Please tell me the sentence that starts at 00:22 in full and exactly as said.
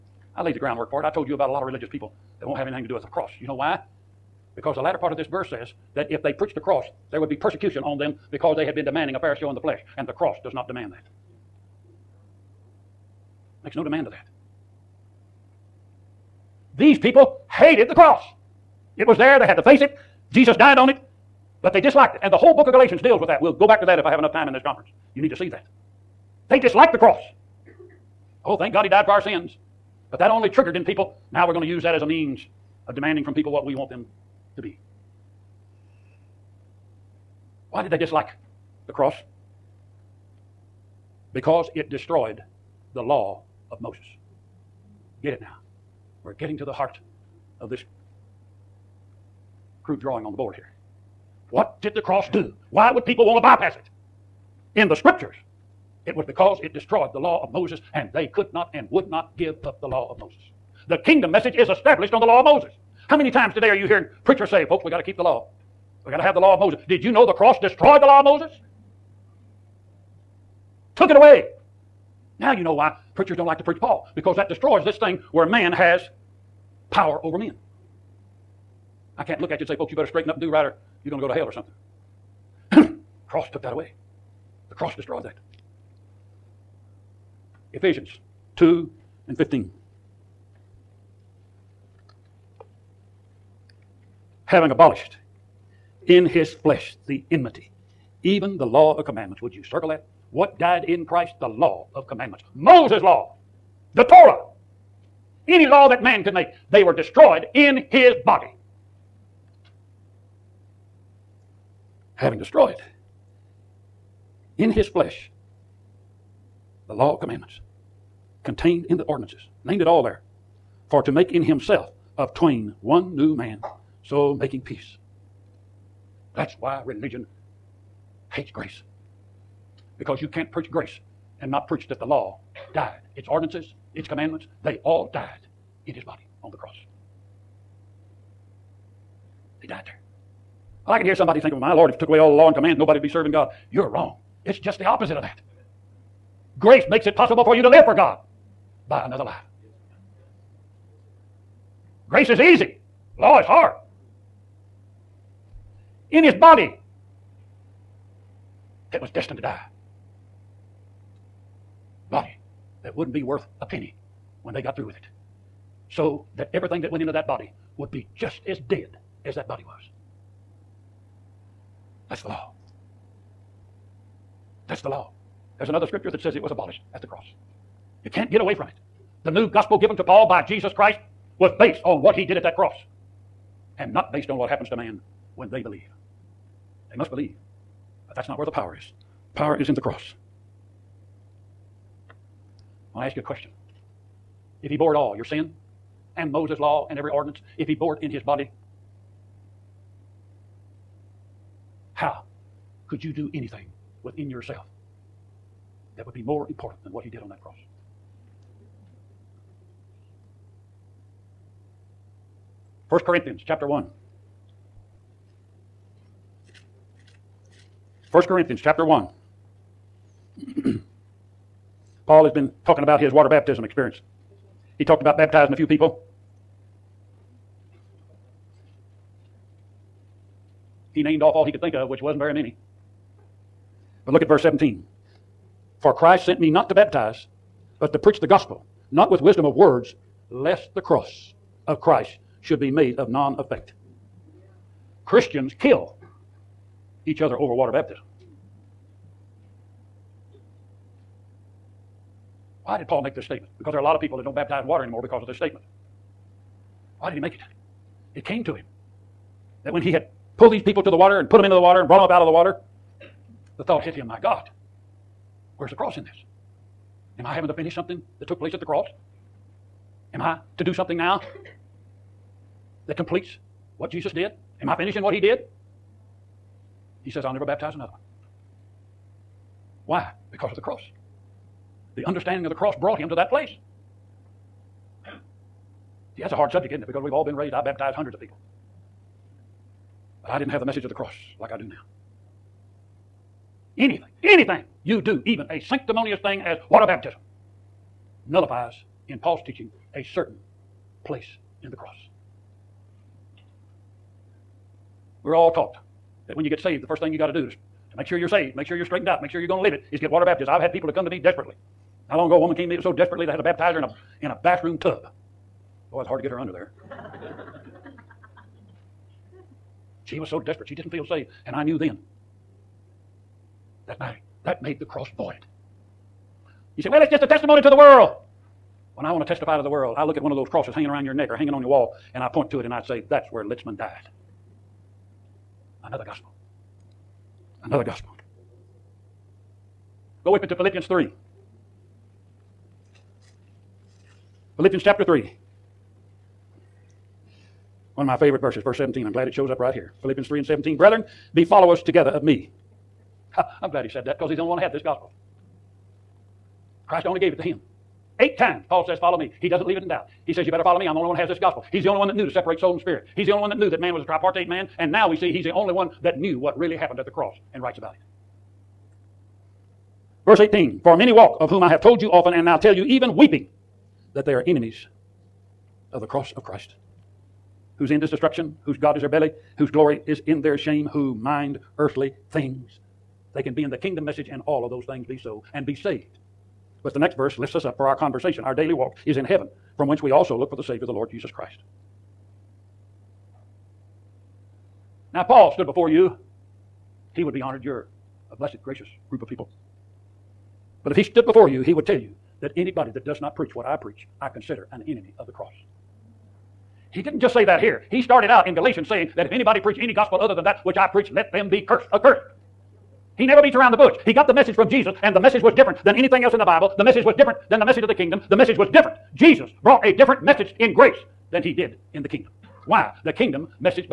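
And the whole book of Galatians deals with that.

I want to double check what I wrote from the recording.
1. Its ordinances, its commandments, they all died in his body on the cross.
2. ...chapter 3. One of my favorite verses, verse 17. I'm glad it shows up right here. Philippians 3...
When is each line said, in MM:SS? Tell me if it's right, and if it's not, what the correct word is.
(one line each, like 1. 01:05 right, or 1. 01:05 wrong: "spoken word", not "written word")
1. 02:13 right
2. 05:44 right.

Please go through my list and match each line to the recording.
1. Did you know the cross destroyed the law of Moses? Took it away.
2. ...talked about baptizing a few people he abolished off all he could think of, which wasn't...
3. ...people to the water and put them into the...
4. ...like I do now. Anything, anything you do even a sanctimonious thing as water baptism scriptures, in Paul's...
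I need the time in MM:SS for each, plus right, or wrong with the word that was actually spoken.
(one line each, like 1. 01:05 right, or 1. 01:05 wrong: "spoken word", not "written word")
1. 01:06 right
2. 03:44 wrong: "named", not "abolished"
3. 04:20 right
4. 04:51 wrong: "nullifies", not "scriptures".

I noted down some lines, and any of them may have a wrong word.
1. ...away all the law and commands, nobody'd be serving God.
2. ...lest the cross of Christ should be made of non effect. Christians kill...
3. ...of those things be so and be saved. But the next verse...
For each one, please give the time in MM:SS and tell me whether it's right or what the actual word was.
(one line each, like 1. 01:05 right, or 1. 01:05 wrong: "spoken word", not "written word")
1. 02:22 right
2. 04:00 right
3. 06:24 right.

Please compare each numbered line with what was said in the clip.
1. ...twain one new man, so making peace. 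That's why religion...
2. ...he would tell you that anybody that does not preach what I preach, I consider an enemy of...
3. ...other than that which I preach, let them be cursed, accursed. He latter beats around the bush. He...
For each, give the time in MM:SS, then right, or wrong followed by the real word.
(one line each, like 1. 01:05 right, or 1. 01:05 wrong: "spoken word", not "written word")
1. 02:02 right
2. 06:41 right
3. 06:50 wrong: "never", not "latter".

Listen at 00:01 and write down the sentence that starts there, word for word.
I told you about a lot of religious people that won't have anything to do with the cross.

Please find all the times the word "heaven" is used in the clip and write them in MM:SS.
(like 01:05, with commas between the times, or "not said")
06:29.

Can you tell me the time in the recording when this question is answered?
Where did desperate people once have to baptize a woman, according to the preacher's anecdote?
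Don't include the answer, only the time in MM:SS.
05:14.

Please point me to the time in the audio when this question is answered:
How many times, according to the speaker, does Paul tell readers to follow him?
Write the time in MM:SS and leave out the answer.
05:58.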